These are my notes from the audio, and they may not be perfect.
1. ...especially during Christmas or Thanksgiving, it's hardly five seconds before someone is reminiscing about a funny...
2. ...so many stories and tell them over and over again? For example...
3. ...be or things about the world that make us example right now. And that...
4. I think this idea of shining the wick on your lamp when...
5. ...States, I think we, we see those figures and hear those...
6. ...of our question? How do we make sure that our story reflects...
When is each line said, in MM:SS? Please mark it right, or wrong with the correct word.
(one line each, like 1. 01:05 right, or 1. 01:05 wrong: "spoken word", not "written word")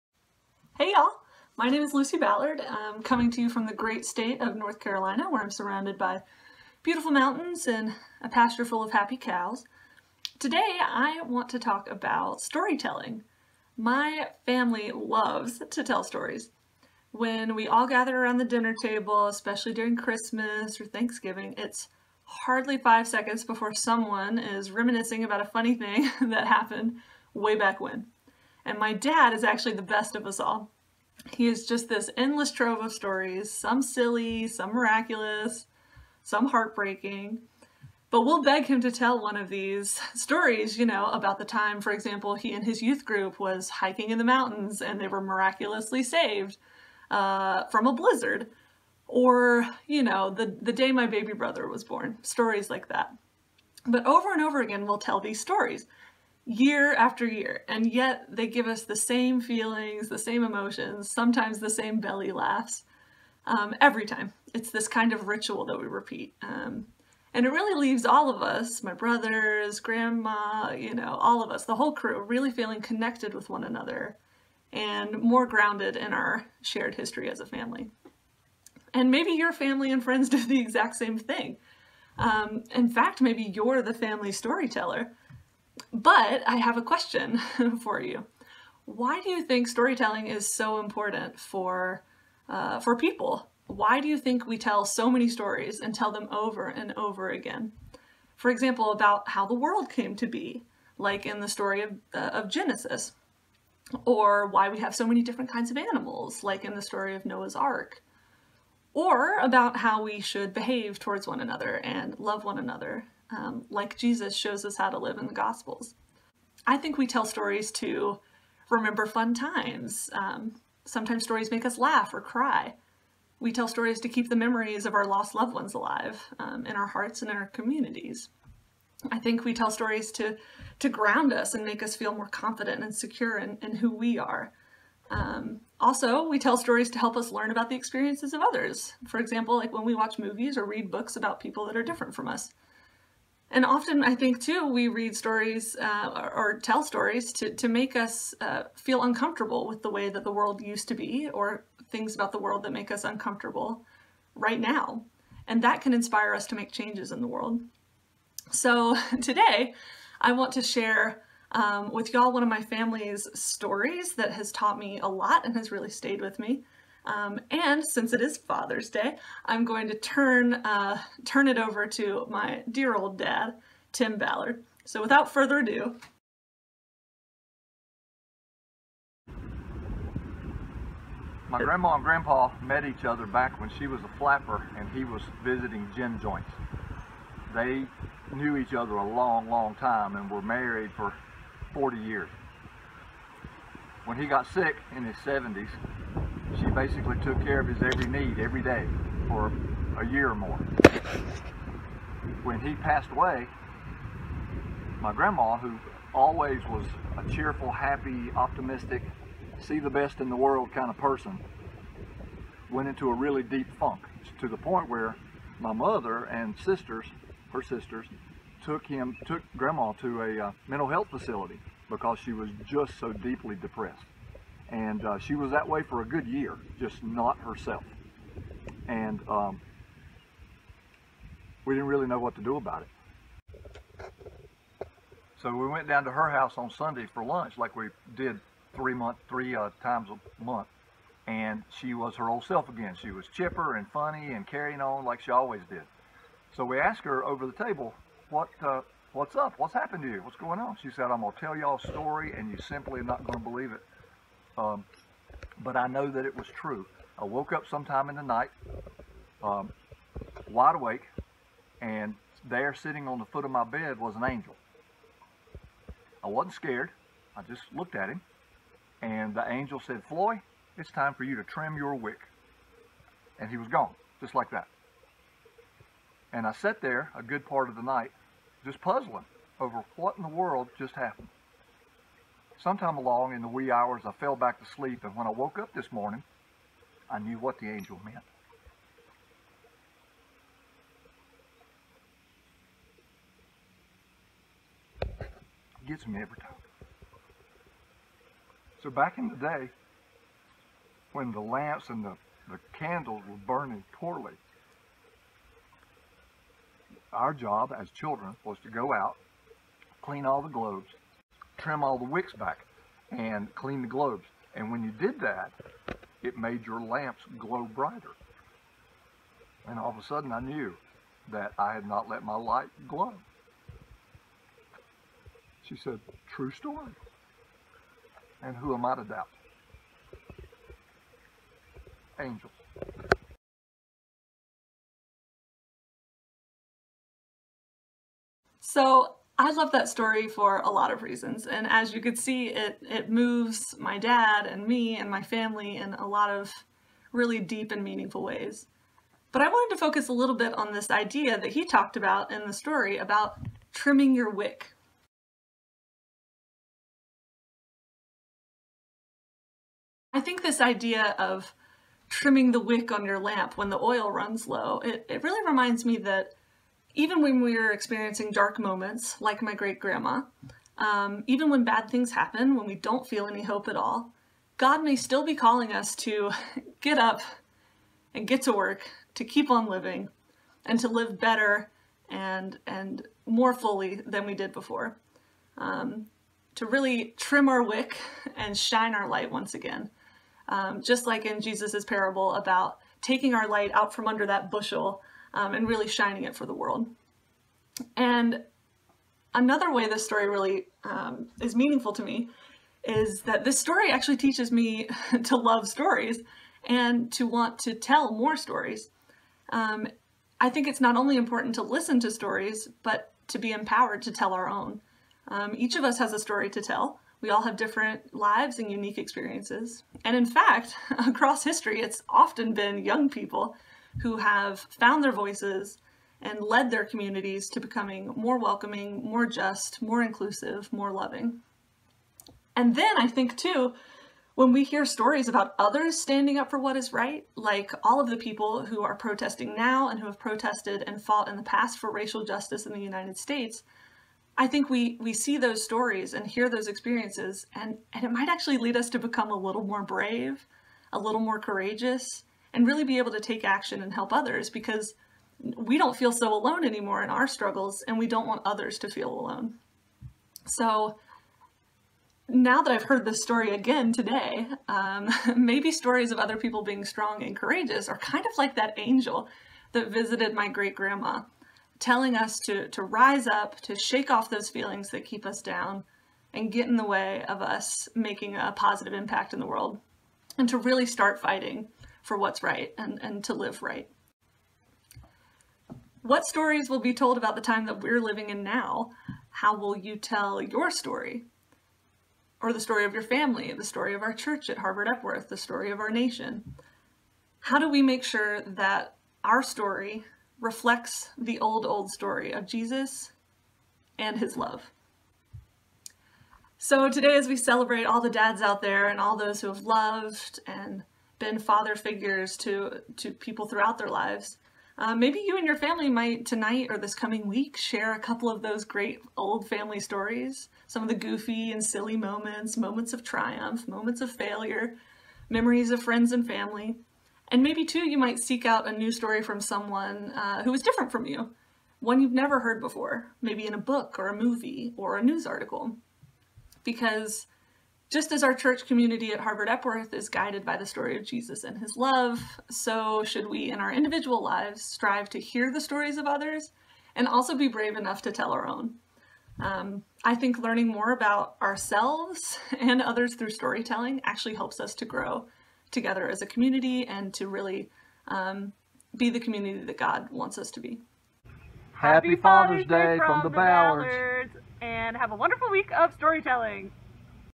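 1. 00:19 right
2. 01:34 right
3. 02:30 wrong: "uncomfortable", not "example"
4. 06:00 wrong: "trimming", not "shining"
5. 07:23 wrong: "stories", not "figures"
6. 08:15 wrong: "nation", not "question".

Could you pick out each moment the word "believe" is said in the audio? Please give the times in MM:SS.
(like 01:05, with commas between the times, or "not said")
04:13.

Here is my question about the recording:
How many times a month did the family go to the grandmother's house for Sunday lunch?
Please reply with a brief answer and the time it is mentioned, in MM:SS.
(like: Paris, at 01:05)
3, at 03:59.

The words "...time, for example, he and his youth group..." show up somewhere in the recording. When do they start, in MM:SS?
00:41.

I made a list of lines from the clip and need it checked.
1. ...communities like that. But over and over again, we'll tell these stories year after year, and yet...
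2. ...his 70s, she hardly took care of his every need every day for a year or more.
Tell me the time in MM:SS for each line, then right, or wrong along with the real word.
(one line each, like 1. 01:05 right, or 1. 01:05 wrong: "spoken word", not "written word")
1. 00:52 wrong: "stories", not "communities"
2. 03:15 wrong: "basically", not "hardly".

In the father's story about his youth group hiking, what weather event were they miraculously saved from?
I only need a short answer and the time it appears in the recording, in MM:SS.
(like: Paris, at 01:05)
A blizzard, at 00:47.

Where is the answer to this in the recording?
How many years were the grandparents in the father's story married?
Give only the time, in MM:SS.
03:11.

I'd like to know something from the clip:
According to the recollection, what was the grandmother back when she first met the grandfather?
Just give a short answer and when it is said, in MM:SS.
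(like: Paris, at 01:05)
A flapper, at 03:04.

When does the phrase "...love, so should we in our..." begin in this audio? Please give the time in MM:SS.
09:01.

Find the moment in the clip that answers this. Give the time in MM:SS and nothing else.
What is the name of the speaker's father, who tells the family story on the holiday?
02:53.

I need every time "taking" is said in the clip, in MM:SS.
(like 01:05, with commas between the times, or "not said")
06:33.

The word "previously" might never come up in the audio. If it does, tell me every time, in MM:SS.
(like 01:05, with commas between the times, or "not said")
not said.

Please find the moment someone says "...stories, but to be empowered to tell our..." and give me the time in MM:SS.
06:52.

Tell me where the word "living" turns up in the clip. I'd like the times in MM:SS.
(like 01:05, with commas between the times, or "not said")
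06:19, 08:08.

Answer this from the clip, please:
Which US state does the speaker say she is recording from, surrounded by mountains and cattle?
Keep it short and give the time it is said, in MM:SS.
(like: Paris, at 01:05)
North Carolina, at 00:04.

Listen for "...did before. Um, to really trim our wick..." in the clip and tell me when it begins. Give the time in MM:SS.
06:24.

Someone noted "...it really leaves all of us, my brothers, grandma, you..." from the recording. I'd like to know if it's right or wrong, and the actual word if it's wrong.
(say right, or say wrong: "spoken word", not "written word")
right.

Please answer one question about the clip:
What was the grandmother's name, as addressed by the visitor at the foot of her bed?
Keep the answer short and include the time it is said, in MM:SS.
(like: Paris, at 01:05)
Floy, at 04:30.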